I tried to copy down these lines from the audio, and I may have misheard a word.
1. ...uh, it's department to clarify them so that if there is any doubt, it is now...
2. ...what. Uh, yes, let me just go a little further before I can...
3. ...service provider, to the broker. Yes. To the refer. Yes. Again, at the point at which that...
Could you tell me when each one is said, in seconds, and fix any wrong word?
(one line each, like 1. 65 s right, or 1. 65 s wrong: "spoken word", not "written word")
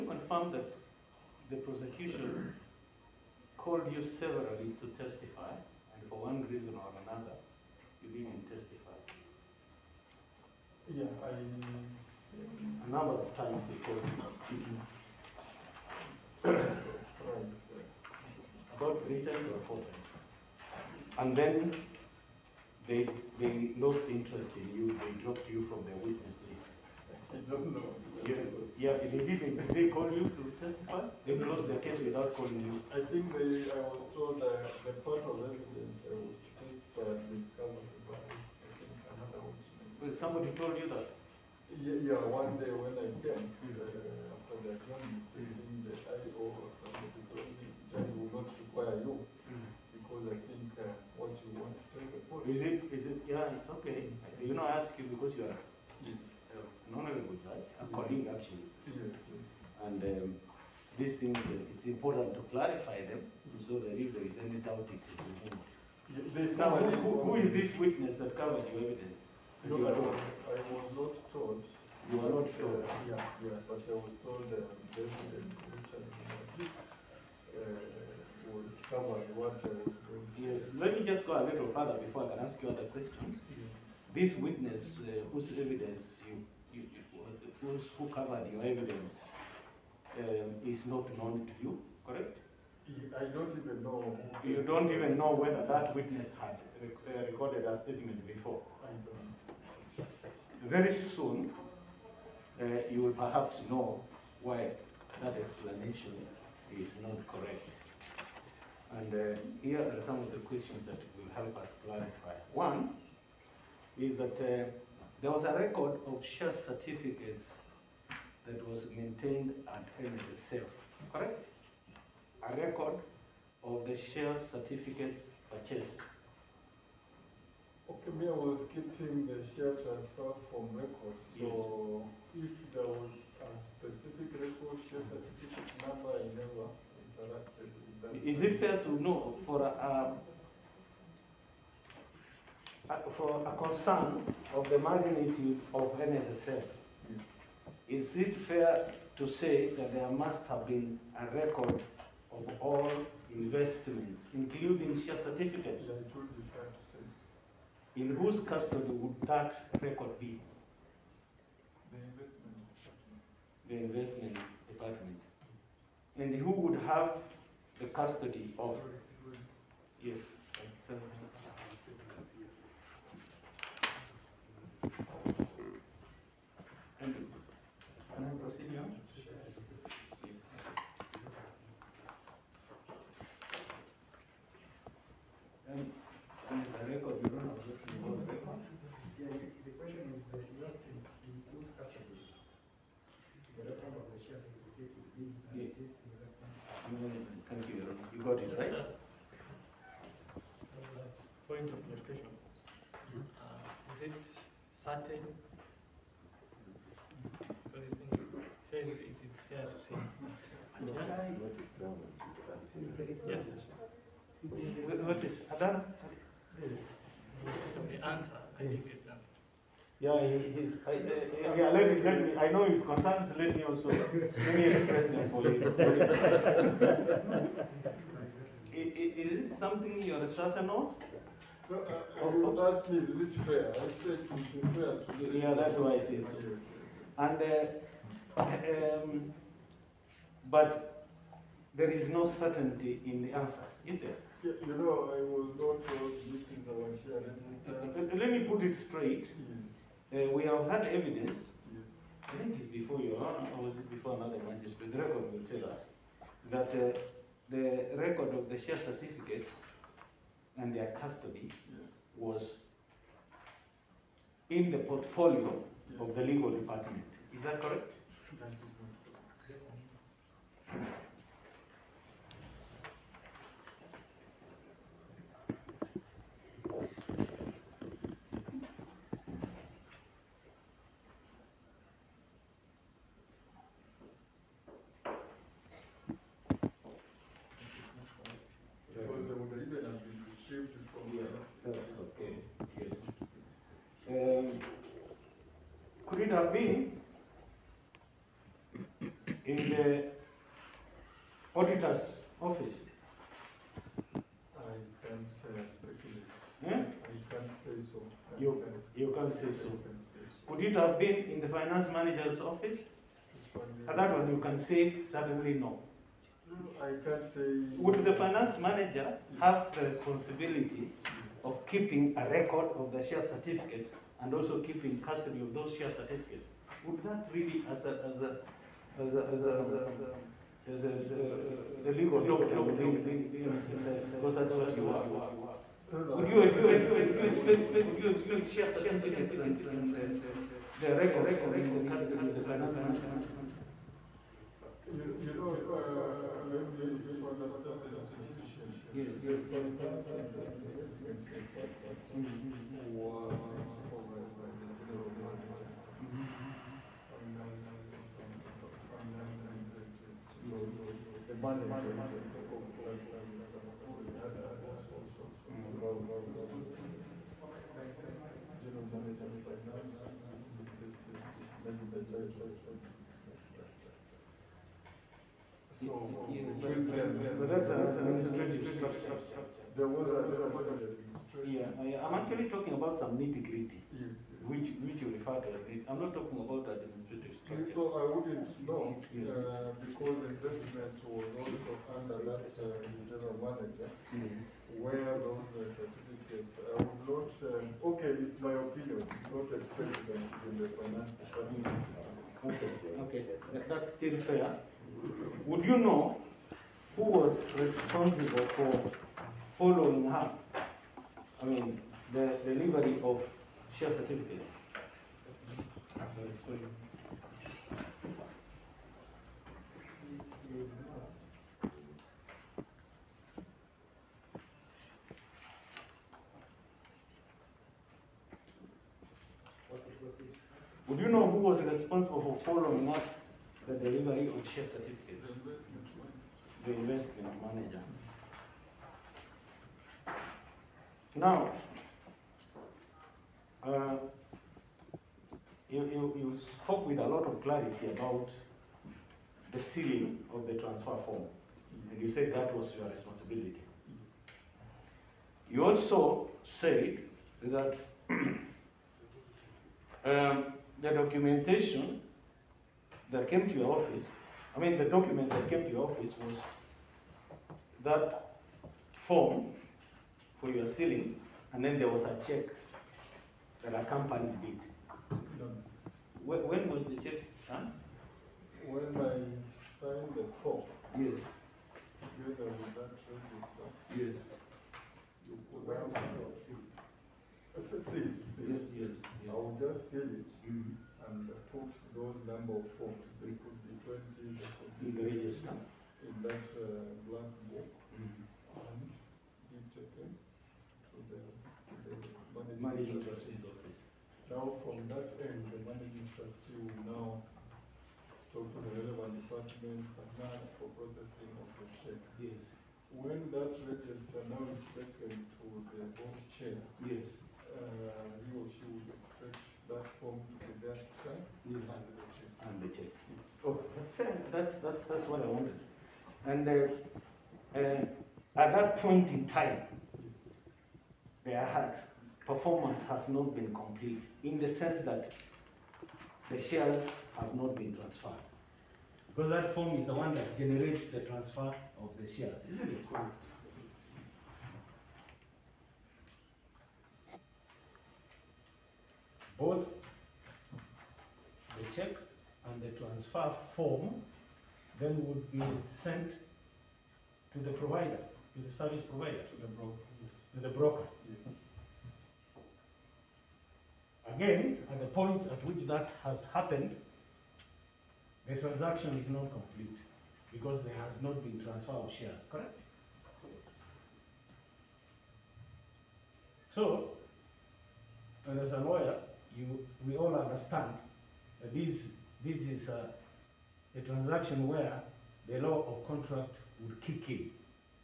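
1. 61 s wrong: "important", not "department"
2. 79 s right
3. 558 s wrong: "broker", not "refer".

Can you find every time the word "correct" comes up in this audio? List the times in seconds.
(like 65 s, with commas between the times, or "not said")
92 s, 107 s, 121 s, 267 s, 572 s.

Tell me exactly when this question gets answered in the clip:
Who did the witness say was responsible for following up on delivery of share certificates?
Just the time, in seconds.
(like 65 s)
436 s.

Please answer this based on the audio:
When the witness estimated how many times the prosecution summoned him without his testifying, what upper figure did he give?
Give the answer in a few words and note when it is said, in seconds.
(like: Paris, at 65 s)
4 times, at 19 s.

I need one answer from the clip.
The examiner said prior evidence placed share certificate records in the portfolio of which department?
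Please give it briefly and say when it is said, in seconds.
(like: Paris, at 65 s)
Legal department, at 266 s.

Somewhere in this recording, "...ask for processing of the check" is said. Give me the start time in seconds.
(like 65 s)
510 s.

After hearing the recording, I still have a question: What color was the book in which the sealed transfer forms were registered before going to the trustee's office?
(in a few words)
Black.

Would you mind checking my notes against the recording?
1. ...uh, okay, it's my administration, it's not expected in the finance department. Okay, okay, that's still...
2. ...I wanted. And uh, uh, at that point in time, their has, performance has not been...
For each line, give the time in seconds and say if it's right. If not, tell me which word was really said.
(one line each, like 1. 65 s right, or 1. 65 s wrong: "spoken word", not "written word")
1. 397 s wrong: "opinion", not "administration"
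2. 525 s right.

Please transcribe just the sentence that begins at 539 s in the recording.
Because that form is the one that generates the transfer of the shares, isn't it?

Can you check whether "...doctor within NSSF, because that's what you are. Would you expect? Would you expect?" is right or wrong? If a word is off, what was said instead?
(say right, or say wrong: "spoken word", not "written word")
right.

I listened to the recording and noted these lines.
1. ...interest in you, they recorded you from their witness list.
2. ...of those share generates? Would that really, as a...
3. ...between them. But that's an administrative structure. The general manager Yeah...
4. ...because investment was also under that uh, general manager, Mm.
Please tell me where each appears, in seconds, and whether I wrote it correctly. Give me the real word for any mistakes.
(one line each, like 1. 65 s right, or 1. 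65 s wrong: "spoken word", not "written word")
1. 24 s wrong: "dropped", not "recorded"
2. 325 s wrong: "certificates", not "generates"
3. 376 s right
4. 389 s right.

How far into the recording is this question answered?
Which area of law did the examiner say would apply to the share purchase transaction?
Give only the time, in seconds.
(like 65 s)
585 s.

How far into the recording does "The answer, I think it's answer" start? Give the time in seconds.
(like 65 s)
217 s.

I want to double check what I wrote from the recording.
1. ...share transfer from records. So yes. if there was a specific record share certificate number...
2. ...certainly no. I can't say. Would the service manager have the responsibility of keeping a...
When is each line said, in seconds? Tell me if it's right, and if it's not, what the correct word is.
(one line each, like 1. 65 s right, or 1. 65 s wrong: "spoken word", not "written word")
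1. 129 s right
2. 315 s wrong: "finance", not "service".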